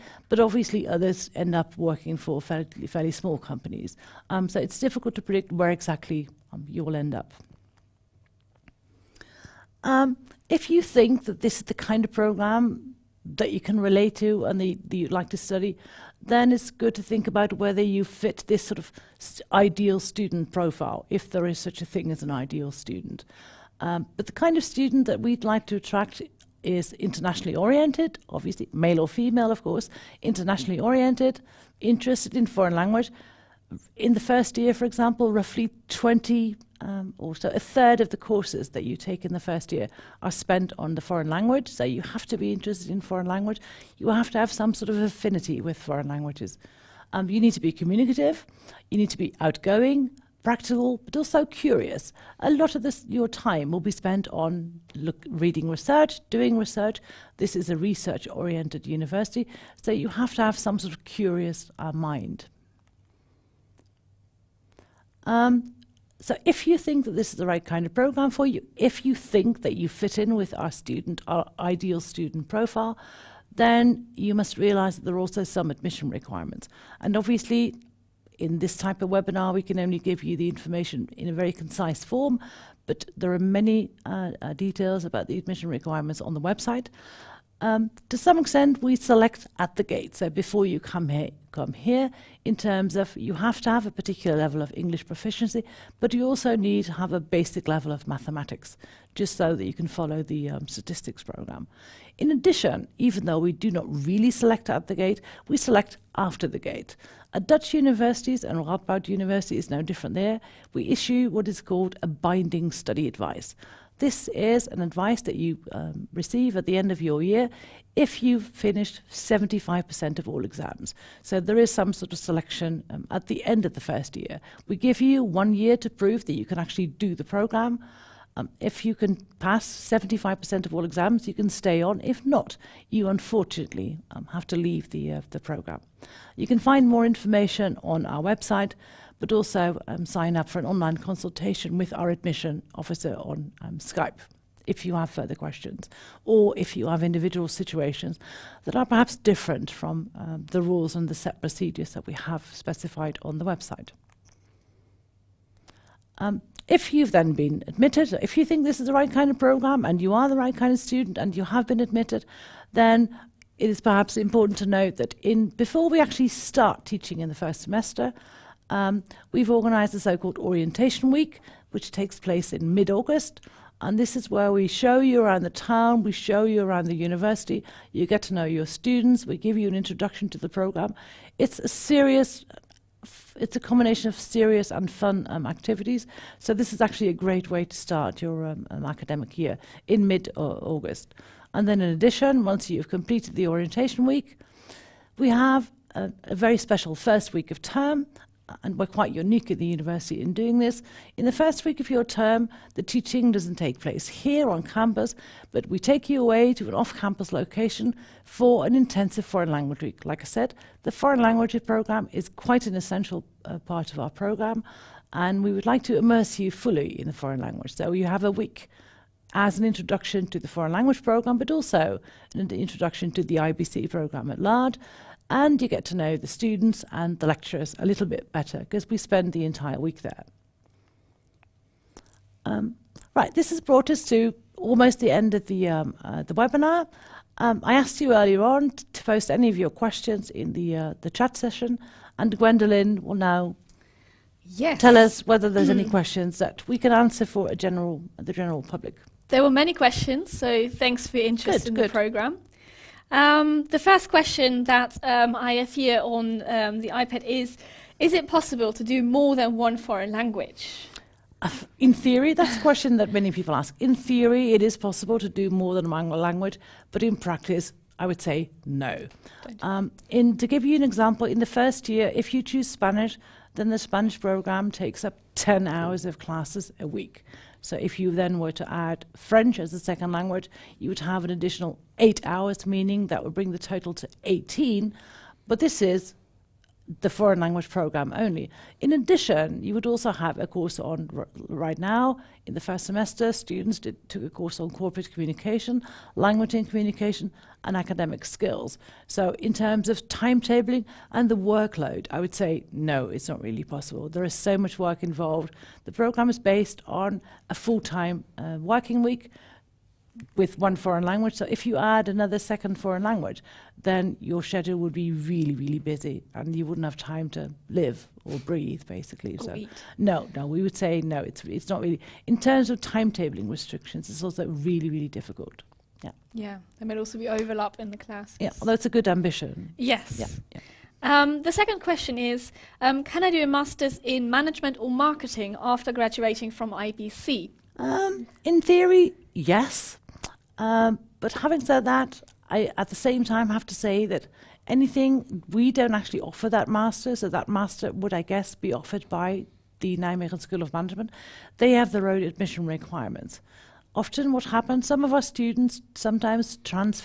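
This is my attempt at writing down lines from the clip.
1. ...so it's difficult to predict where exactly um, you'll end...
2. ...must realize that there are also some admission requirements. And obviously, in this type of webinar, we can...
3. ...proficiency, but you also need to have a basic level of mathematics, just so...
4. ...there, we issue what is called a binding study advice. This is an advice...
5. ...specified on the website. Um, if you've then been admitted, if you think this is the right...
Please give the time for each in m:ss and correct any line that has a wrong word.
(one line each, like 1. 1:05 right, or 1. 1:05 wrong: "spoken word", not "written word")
1. 0:04 right
2. 1:14 right
3. 1:35 right
4. 1:50 right
5. 2:32 right.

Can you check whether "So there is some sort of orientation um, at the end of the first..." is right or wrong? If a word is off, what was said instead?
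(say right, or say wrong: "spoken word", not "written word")
wrong: "selection", not "orientation".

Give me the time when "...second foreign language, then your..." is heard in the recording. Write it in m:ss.
5:12.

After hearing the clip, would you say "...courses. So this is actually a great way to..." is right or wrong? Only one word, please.
wrong.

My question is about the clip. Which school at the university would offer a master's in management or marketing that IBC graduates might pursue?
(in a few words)
Nijmegen School of Management.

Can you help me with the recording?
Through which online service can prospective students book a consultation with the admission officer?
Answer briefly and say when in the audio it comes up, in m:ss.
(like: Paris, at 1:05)
Skype, at 2:23.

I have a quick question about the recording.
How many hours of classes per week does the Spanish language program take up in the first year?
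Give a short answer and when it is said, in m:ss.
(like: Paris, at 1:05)
10, at 4:35.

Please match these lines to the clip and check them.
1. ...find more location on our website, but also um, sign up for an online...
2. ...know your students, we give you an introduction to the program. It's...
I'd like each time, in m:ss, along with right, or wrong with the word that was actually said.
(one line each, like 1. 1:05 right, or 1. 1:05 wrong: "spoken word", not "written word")
1. 2:16 wrong: "information", not "location"
2. 2:58 right.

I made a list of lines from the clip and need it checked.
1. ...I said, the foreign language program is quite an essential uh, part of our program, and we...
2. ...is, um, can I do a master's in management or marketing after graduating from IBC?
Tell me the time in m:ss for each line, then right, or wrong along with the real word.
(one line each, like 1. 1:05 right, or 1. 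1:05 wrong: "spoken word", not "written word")
1. 3:30 right
2. 5:32 right.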